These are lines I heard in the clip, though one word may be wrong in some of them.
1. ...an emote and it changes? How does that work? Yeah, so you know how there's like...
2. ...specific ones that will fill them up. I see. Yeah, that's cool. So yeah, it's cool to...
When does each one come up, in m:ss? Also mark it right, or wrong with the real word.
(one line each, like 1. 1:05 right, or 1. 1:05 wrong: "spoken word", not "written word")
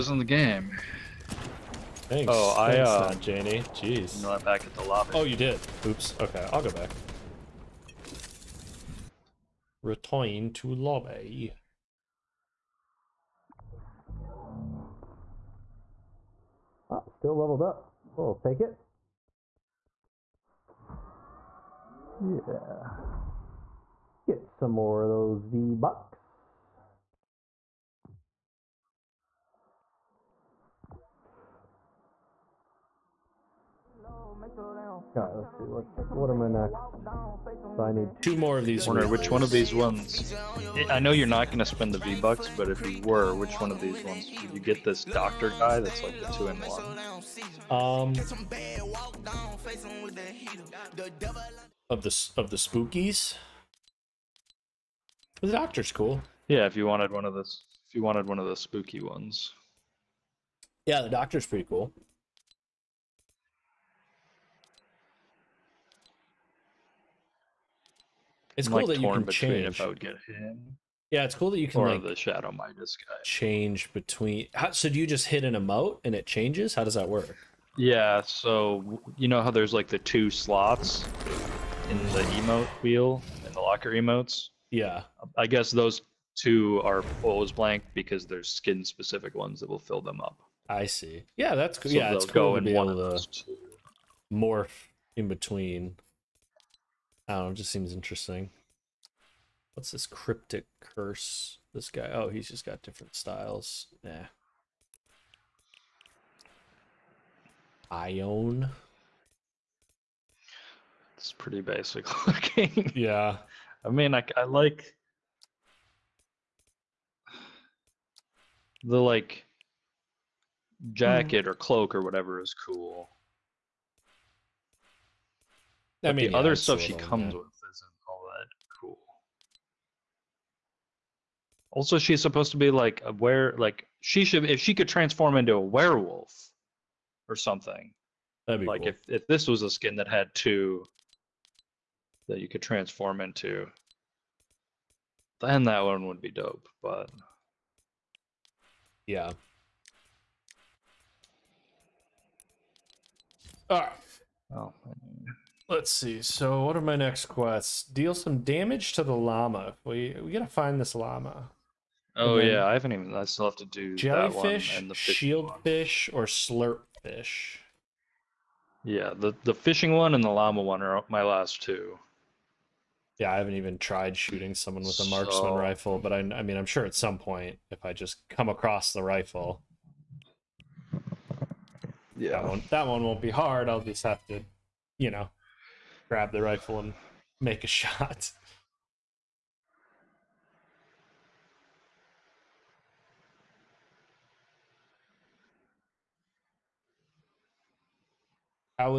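1. 1:15 right
2. 1:28 right.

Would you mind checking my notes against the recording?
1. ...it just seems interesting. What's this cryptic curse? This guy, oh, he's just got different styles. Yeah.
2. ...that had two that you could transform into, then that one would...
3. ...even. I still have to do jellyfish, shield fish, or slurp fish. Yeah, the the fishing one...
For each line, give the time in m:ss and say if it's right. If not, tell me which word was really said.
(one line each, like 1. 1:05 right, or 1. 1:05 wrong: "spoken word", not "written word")
1. 1:37 right
2. 2:19 right
3. 2:42 right.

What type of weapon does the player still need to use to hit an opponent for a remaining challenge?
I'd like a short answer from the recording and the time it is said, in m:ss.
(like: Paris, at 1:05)
Marksman rifle, at 2:55.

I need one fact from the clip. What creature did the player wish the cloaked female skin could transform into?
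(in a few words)
A werewolf.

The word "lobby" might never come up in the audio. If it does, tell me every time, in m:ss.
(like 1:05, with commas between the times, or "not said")
0:04, 0:10.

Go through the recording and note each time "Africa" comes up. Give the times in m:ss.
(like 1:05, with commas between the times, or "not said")
not said.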